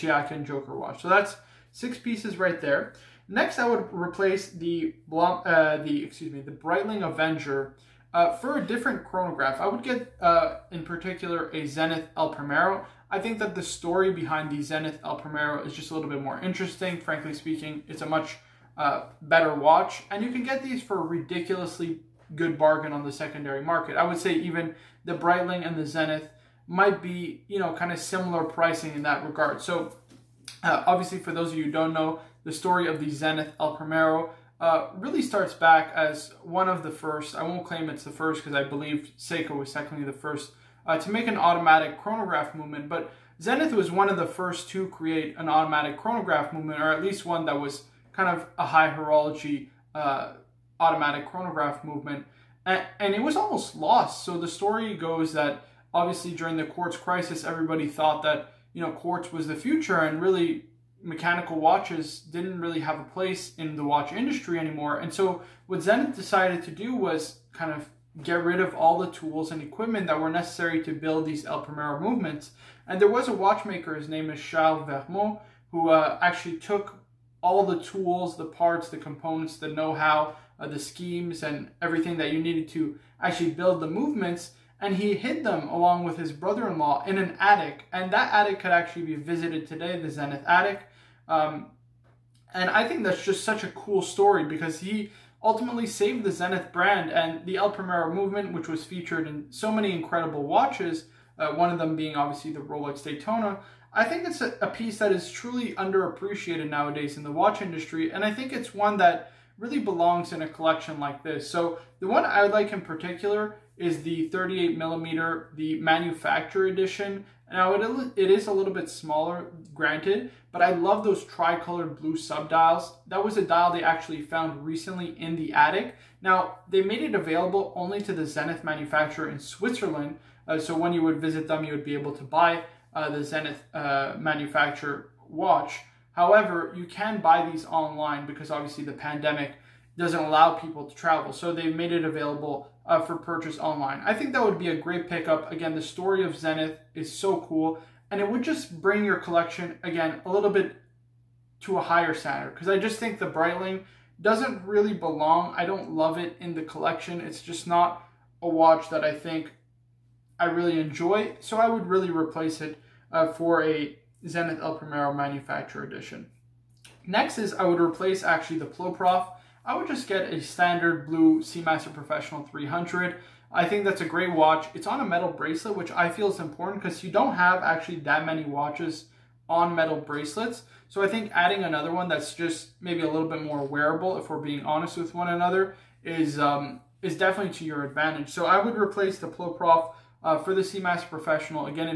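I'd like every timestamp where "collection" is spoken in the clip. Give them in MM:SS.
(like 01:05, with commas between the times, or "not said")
01:50, 02:29, 02:36.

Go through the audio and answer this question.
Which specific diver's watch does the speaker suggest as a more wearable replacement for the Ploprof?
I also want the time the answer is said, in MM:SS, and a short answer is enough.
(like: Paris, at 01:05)
Seamaster Professional 300, at 02:51.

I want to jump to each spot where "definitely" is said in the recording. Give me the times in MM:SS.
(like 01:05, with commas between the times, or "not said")
03:07.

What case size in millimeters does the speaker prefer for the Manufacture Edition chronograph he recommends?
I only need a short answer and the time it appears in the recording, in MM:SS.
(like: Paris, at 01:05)
38 millimeter, at 01:54.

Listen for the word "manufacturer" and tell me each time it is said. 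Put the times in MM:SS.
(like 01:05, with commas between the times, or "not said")
01:55, 02:08, 02:14, 02:45.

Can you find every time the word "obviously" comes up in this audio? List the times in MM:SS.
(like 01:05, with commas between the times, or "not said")
00:30, 00:55, 01:42, 02:18.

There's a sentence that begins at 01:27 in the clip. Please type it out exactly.
And that attic could actually be visited today, the Zenith attic.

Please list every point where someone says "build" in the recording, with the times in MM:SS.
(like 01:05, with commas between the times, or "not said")
01:10, 01:23.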